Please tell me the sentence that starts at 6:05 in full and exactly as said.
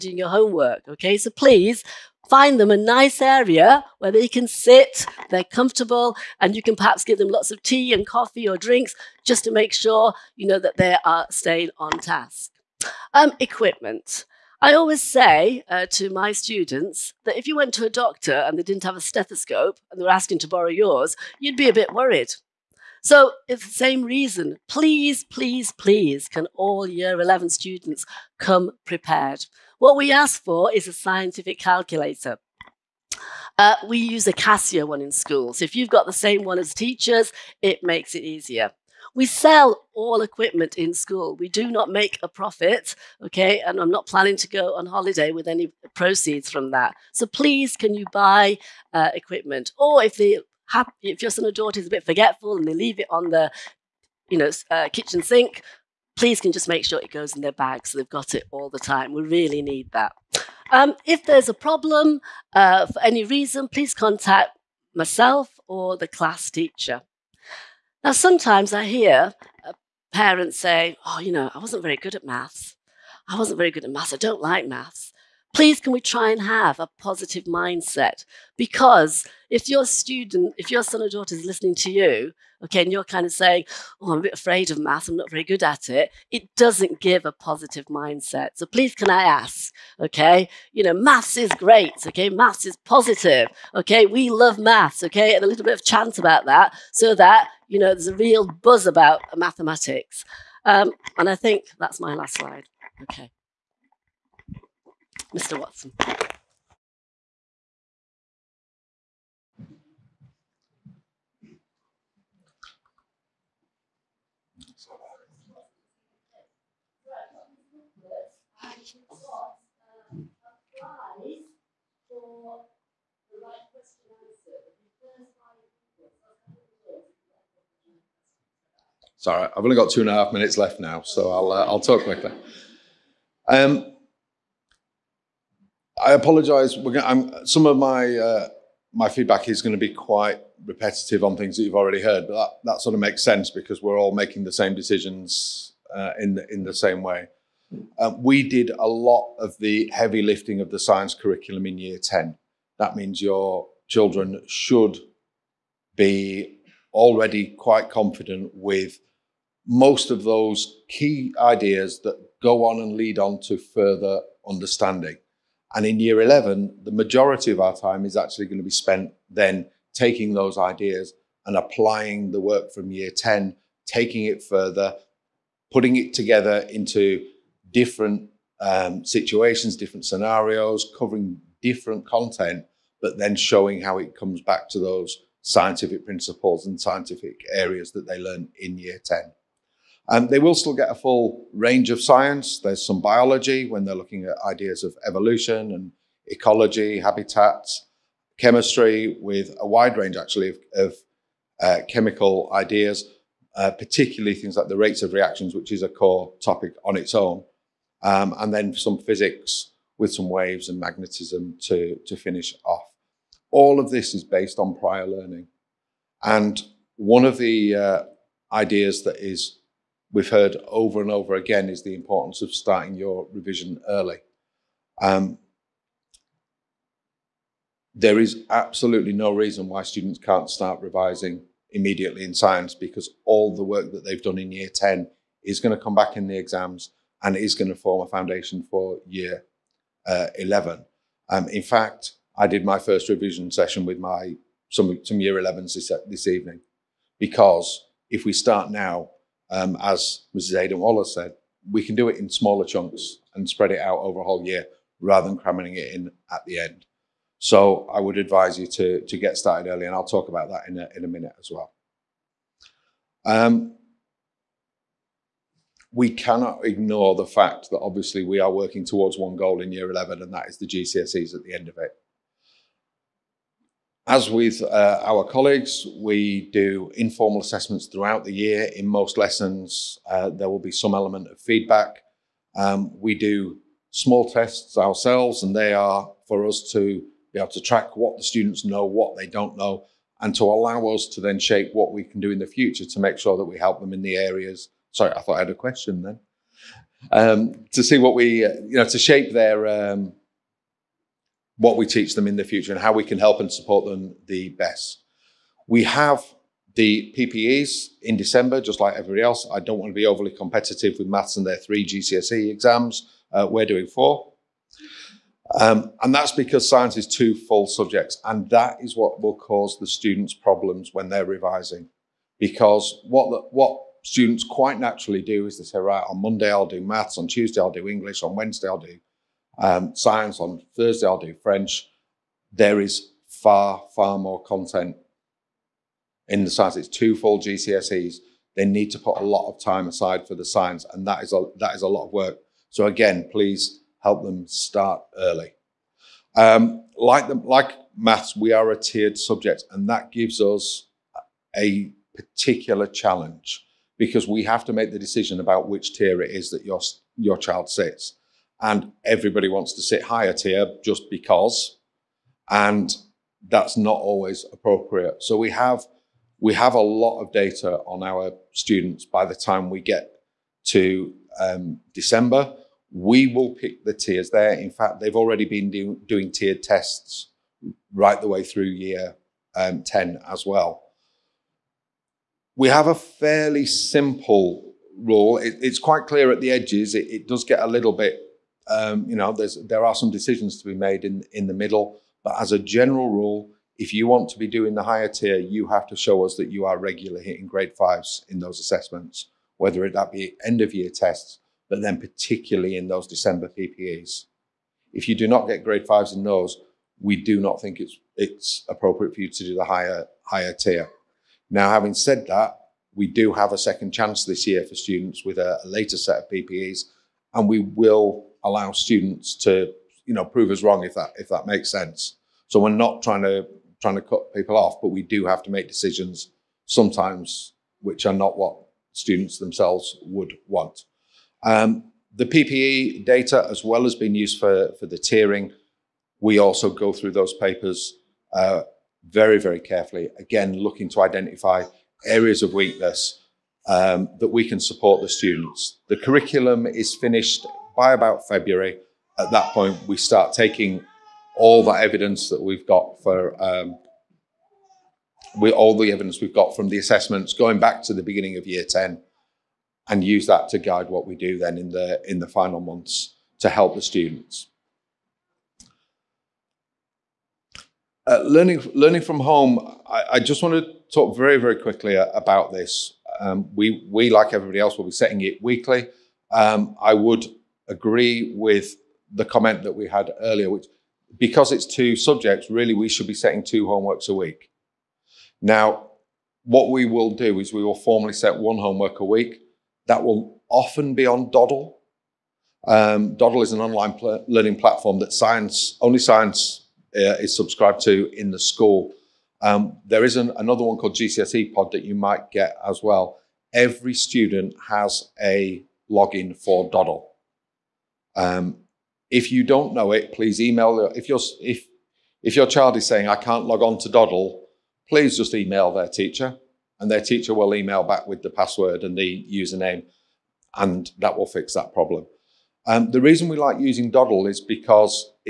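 So we have we have a lot of data on our students by the time we get to um, December.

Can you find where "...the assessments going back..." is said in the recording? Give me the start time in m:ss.
7:36.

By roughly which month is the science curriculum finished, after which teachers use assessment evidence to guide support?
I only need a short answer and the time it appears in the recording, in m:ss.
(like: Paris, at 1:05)
February, at 7:28.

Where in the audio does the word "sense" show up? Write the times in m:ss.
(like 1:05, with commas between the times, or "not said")
2:23, 7:01.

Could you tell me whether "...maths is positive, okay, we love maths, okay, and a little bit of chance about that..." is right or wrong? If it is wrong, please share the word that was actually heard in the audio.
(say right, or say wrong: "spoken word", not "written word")
right.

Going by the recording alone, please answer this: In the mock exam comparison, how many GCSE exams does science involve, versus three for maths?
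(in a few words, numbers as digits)
4.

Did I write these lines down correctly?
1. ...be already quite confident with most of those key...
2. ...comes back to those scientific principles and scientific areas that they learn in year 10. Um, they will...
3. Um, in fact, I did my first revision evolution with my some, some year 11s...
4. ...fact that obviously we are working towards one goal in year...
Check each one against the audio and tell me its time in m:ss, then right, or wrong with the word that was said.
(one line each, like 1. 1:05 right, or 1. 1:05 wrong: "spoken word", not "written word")
1. 2:35 right
2. 3:04 right
3. 4:01 wrong: "session", not "evolution"
4. 4:27 right.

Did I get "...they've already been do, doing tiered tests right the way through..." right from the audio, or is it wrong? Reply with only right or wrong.
right.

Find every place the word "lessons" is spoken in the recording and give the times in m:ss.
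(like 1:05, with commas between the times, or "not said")
4:39.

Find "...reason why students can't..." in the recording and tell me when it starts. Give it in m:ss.
3:49.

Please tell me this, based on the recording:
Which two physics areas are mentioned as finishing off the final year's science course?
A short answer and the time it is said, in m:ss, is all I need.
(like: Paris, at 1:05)
waves and magnetism, at 3:30.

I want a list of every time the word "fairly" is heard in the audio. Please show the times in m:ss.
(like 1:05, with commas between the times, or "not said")
6:22.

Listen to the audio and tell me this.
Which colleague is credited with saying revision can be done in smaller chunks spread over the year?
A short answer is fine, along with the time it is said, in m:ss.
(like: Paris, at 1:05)
Mrs. Aidan Waller, at 4:10.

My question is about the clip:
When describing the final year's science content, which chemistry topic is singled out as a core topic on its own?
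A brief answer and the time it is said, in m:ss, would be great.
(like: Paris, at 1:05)
rates of reactions, at 3:24.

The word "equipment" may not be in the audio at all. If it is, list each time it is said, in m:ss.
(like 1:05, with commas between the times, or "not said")
0:13, 0:40, 0:49.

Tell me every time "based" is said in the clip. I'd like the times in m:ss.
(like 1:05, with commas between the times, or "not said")
3:34.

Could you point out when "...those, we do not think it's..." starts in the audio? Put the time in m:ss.
6:46.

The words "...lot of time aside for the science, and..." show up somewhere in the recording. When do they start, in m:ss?
5:39.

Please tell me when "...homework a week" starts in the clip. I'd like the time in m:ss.
8:08.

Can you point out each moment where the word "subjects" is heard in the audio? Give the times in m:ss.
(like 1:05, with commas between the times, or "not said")
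5:17, 5:49, 8:01.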